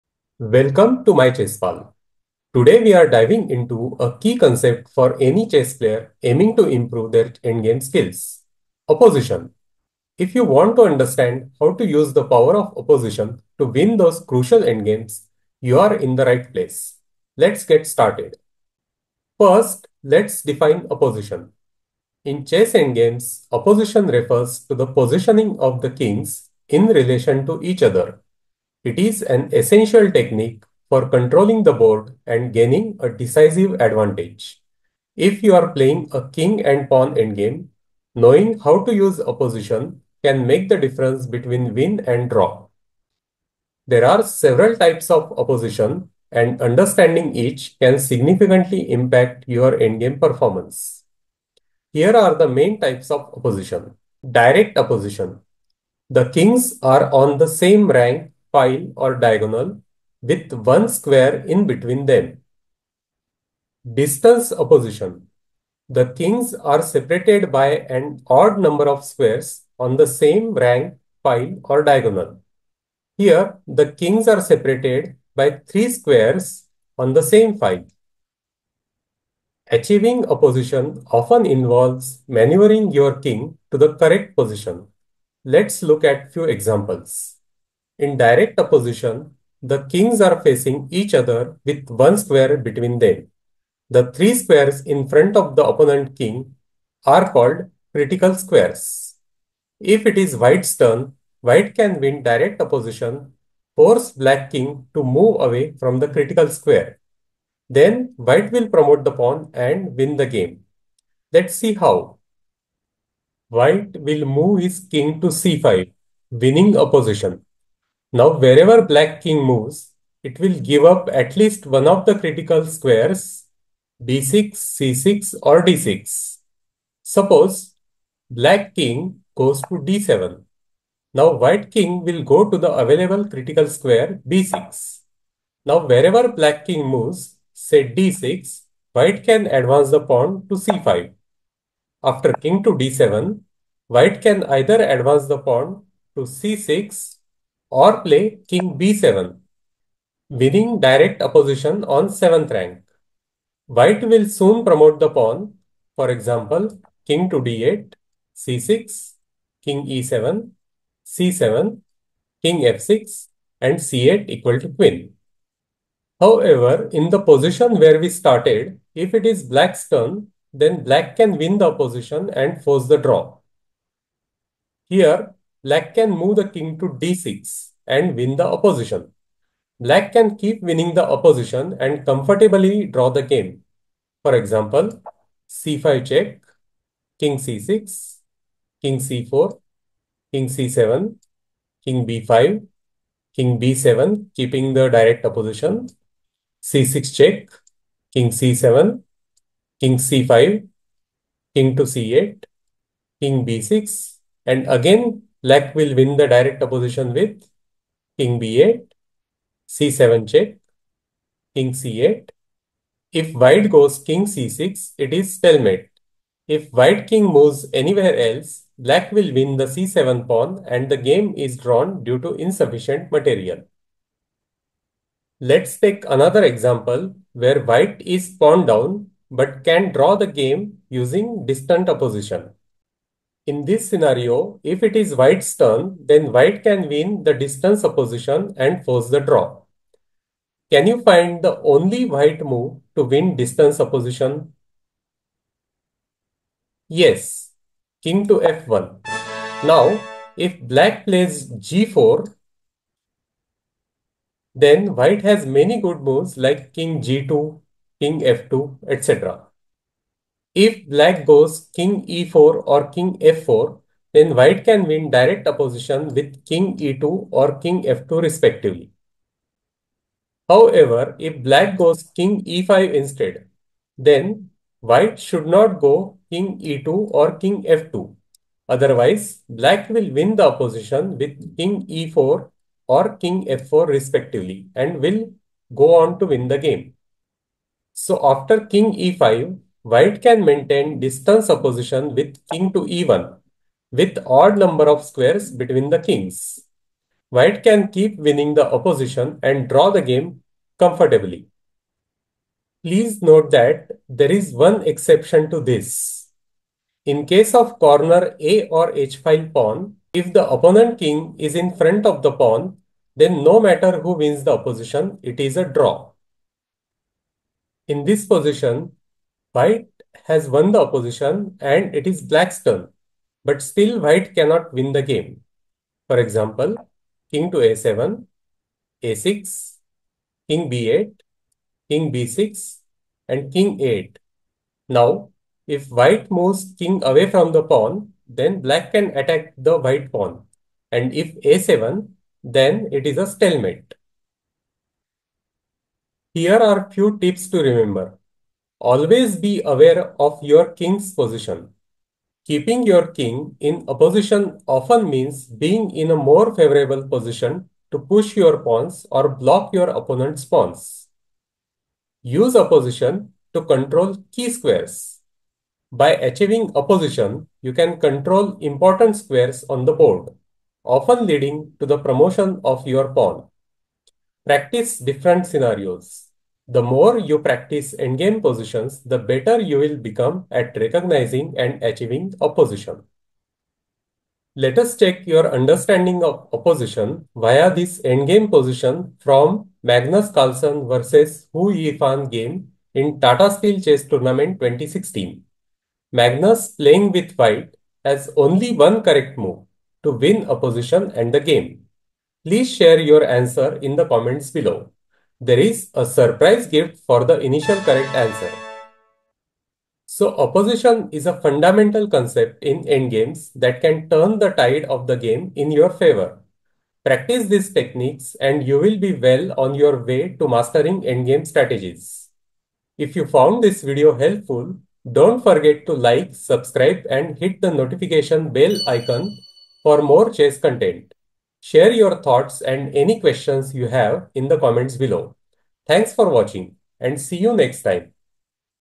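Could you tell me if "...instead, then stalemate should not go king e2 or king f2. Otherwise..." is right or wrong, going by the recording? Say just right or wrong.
wrong.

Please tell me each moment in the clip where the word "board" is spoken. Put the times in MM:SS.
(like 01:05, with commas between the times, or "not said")
00:31, 06:09.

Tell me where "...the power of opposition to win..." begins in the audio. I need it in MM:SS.
00:12.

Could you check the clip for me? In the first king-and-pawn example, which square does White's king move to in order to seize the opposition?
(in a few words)
c5.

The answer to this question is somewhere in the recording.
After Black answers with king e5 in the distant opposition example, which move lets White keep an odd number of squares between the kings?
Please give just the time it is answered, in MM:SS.
04:52.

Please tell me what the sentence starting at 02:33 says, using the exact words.
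White will soon promote the pawn, for example, king to d8, c6, king e7, c7, king f6, and c8 equal to queen.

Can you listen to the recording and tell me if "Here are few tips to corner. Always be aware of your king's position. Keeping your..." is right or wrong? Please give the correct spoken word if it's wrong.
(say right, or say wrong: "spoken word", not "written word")
wrong: "remember", not "corner".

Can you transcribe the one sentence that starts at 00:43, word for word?
There are several types of opposition and understanding each can significantly impact your endgame performance.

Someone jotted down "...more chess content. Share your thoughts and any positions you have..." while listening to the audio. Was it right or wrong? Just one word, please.
wrong.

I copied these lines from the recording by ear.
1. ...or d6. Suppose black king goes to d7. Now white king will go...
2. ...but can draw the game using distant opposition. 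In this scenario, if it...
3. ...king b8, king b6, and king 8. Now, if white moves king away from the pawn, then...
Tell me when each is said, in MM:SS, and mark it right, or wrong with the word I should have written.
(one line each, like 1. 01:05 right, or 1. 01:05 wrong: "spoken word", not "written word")
1. 02:05 right
2. 03:49 right
3. 05:30 right.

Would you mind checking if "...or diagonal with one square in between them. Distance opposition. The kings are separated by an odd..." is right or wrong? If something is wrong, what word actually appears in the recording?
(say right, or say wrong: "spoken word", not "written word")
right.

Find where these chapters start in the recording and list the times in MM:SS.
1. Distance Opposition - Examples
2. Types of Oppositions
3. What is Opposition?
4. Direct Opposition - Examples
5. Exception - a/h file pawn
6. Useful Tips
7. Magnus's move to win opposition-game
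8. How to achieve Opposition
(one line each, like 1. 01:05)
1. 03:44
2. 00:50
3. 00:19
4. 01:53
5. 05:02
6. 05:45
7. 06:30
8. 01:20.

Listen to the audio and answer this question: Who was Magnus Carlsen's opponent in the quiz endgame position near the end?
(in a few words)
Hou Yifan.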